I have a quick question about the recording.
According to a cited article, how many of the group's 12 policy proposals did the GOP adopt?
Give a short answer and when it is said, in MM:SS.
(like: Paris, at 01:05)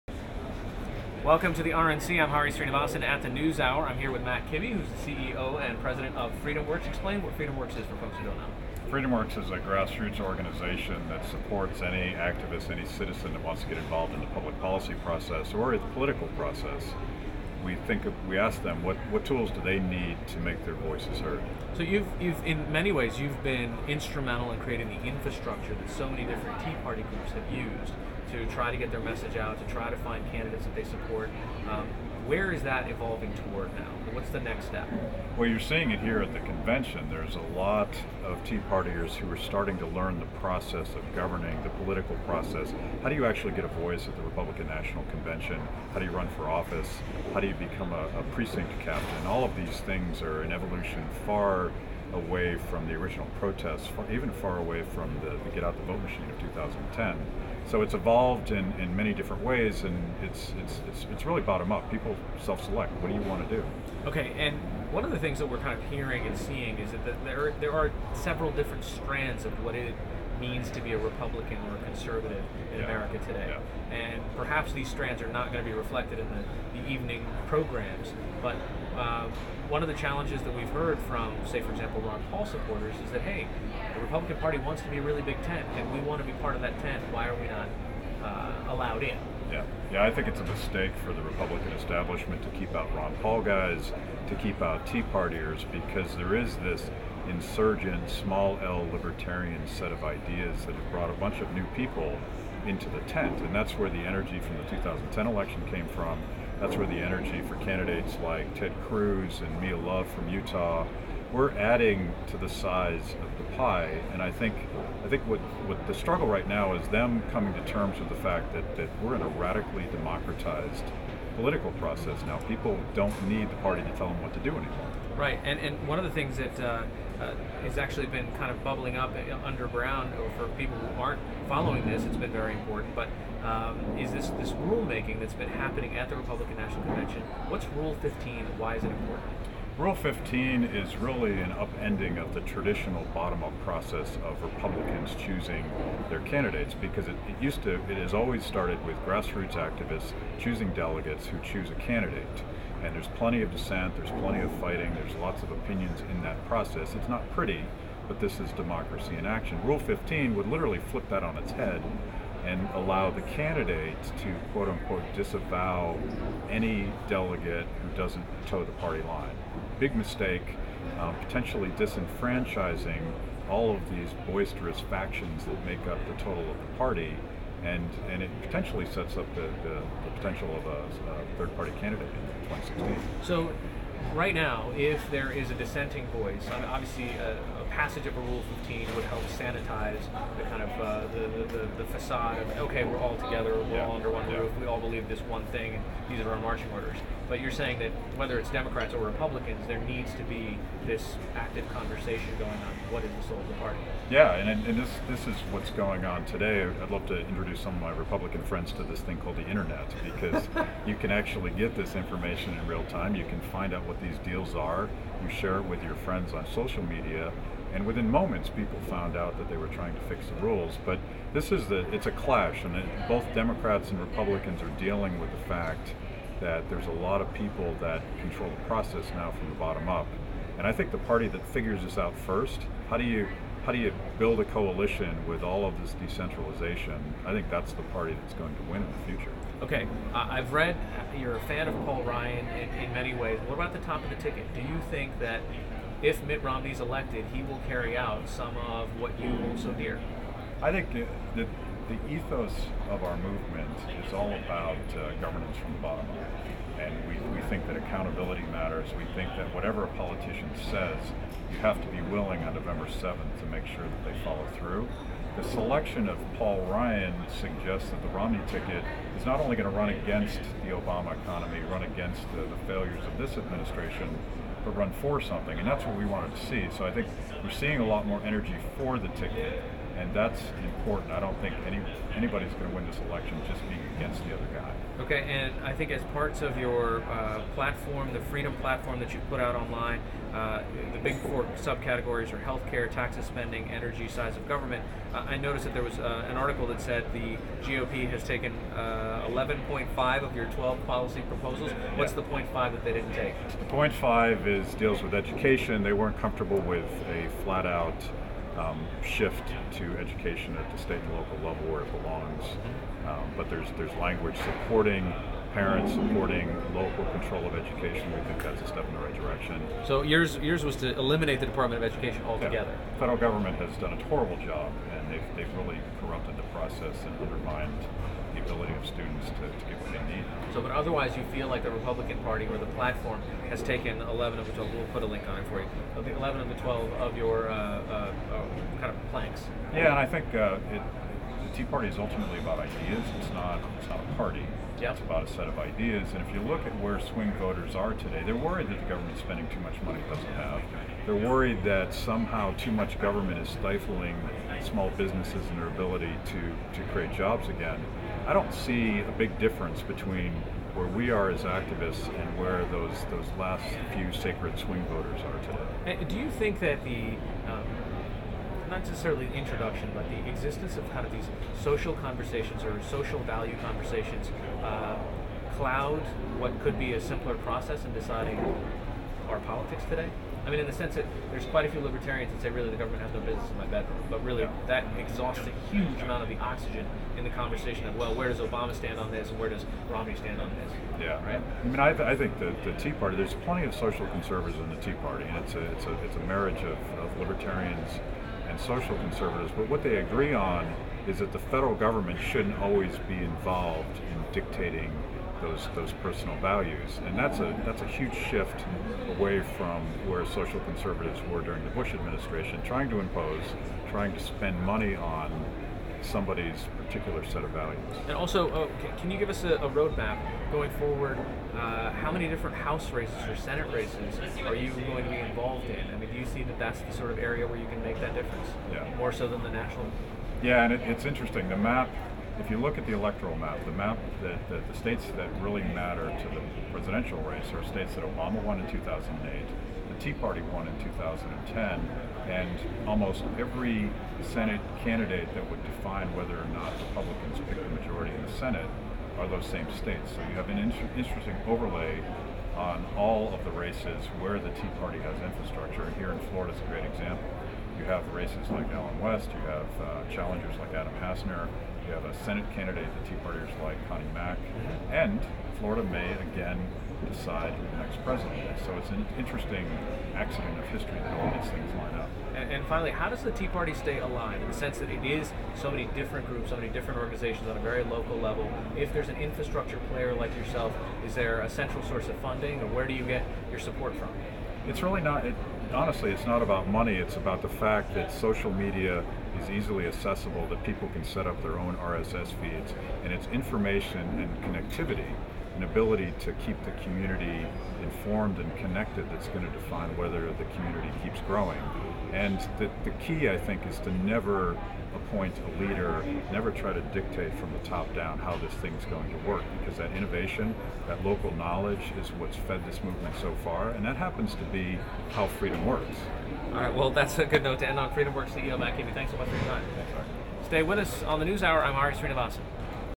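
11.5, at 04:58.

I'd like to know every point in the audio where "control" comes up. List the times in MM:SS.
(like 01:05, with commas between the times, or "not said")
03:48, 05:17.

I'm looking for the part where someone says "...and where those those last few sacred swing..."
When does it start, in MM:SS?
06:02.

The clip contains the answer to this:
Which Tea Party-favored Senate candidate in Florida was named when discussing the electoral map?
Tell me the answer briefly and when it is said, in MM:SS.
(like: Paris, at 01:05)
Connie Mack, at 07:43.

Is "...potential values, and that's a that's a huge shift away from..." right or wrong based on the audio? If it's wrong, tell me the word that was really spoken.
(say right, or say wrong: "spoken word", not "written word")
wrong: "personal", not "potential".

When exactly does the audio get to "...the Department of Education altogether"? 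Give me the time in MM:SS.
05:21.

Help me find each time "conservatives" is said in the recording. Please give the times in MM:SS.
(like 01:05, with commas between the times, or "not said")
01:11, 06:34, 06:38, 06:50.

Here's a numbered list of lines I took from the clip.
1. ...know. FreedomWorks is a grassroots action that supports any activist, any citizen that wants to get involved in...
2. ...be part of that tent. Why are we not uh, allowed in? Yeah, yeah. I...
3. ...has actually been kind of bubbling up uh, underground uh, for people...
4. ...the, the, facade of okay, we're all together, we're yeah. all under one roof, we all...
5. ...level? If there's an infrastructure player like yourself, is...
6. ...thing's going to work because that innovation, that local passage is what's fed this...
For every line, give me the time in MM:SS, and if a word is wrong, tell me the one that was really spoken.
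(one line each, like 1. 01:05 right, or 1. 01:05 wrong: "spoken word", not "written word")
1. 00:08 wrong: "organization", not "action"
2. 01:26 right
3. 02:07 right
4. 03:11 right
5. 07:58 right
6. 08:28 wrong: "knowledge", not "passage".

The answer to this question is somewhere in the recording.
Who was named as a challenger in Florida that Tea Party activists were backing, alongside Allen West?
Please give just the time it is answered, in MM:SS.
07:40.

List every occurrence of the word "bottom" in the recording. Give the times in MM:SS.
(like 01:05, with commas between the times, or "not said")
01:01, 02:23, 03:49, 04:15.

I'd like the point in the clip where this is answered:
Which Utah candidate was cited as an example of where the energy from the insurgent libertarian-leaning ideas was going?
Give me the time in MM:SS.
01:49.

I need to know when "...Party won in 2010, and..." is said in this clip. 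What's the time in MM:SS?
07:20.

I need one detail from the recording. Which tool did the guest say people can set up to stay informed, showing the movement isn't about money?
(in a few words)
RSS feeds.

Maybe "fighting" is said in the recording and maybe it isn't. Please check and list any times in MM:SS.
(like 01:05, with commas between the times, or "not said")
02:34.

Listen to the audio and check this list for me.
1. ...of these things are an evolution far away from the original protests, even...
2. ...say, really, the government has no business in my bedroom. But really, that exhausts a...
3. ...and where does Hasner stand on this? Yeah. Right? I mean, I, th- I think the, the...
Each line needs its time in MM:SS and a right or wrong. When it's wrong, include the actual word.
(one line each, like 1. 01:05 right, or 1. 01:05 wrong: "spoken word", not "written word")
1. 00:49 right
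2. 06:22 right
3. 06:29 wrong: "Romney", not "Hasner".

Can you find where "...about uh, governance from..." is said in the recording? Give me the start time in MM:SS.
04:14.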